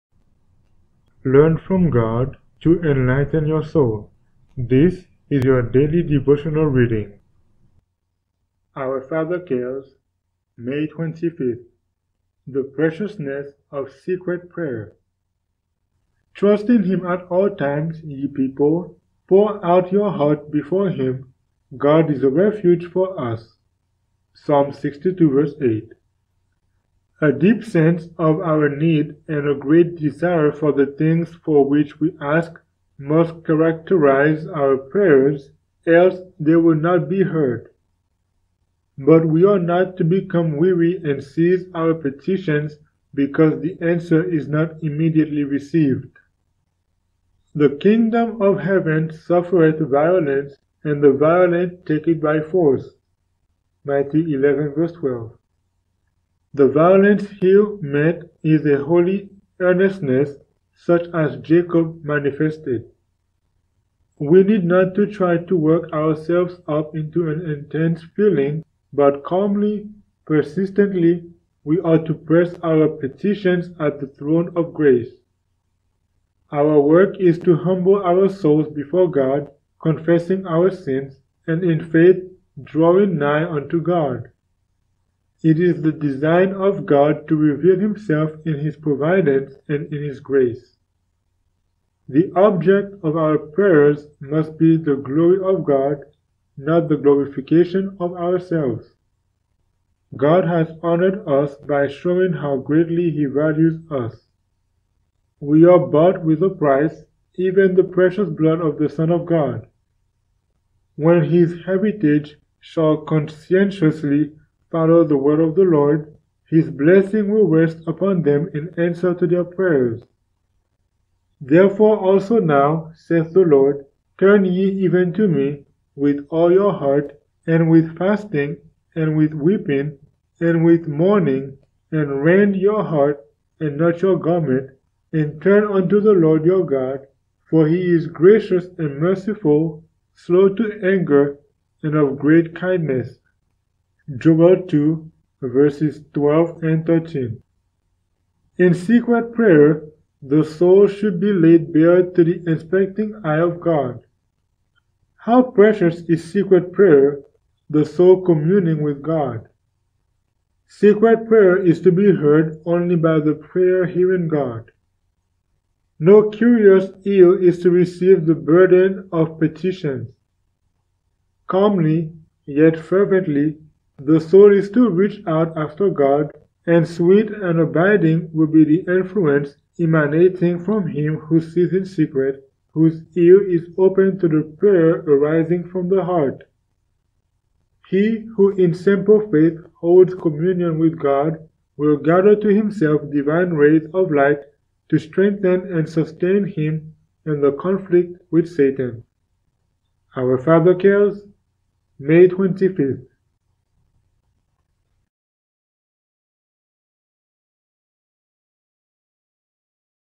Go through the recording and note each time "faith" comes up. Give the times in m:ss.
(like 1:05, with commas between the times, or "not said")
1:21, 3:09.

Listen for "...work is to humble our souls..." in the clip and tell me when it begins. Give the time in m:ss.
1:16.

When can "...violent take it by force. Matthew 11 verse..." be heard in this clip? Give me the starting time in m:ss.
0:51.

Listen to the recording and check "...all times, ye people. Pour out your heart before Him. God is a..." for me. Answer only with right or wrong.
right.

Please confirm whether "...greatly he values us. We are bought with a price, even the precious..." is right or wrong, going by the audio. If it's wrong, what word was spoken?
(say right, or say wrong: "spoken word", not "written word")
right.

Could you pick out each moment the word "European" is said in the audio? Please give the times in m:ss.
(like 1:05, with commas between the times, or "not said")
not said.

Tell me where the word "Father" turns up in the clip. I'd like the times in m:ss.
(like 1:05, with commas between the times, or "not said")
0:09, 3:20.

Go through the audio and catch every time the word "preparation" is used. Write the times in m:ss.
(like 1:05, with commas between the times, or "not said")
not said.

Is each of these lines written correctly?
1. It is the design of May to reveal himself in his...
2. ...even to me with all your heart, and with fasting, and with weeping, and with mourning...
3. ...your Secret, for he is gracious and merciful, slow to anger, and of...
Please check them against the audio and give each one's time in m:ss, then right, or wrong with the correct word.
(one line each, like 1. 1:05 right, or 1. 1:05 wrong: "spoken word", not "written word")
1. 1:25 wrong: "God", not "May"
2. 2:04 right
3. 2:16 wrong: "God", not "Secret".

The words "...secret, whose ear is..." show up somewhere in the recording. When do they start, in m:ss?
3:01.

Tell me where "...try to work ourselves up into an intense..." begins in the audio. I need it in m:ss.
1:05.